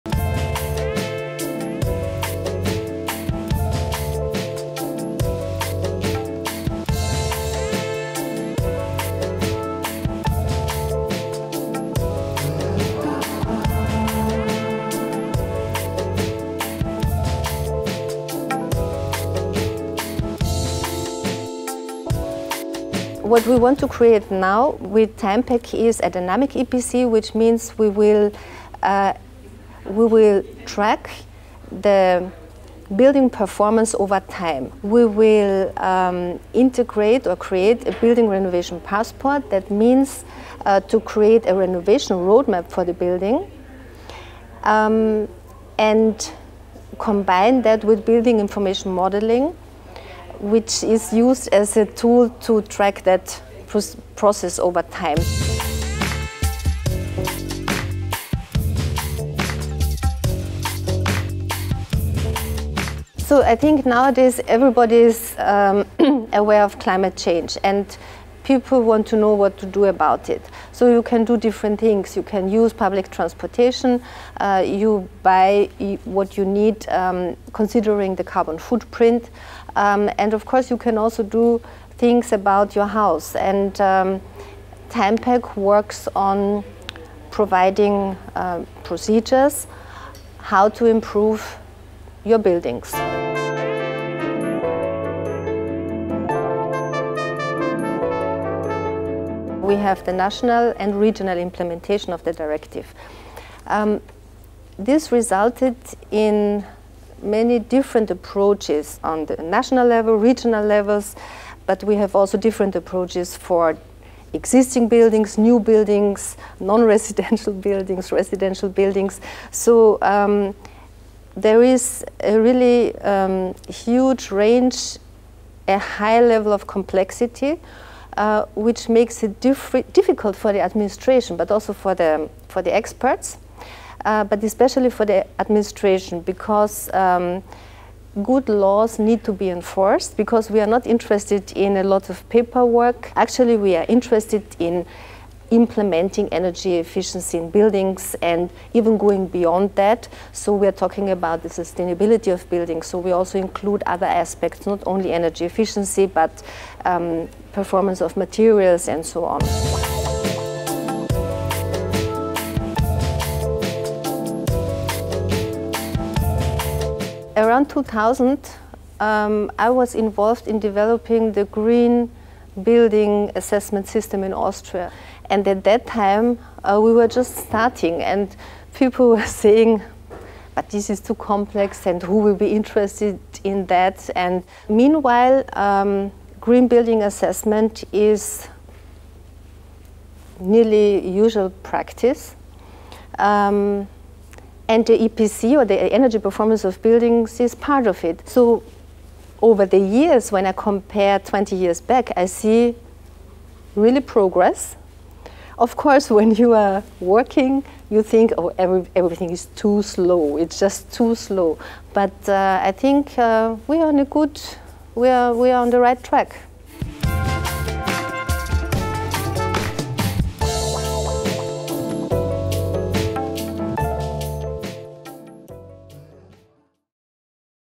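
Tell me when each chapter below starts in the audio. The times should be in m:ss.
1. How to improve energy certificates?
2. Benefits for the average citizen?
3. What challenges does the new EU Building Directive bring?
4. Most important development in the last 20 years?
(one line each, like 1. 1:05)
1. 0:18
2. 0:57
3. 1:37
4. 2:41.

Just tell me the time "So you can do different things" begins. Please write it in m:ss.
1:10.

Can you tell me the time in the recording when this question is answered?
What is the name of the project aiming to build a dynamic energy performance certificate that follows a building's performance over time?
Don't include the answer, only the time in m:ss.
0:25.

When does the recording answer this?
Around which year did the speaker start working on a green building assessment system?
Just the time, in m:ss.
2:47.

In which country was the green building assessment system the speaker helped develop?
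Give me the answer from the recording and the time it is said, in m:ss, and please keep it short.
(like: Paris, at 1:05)
Austria, at 2:54.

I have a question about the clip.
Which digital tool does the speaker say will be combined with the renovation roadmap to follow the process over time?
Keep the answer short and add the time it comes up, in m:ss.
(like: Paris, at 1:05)
Building information modeling, at 0:48.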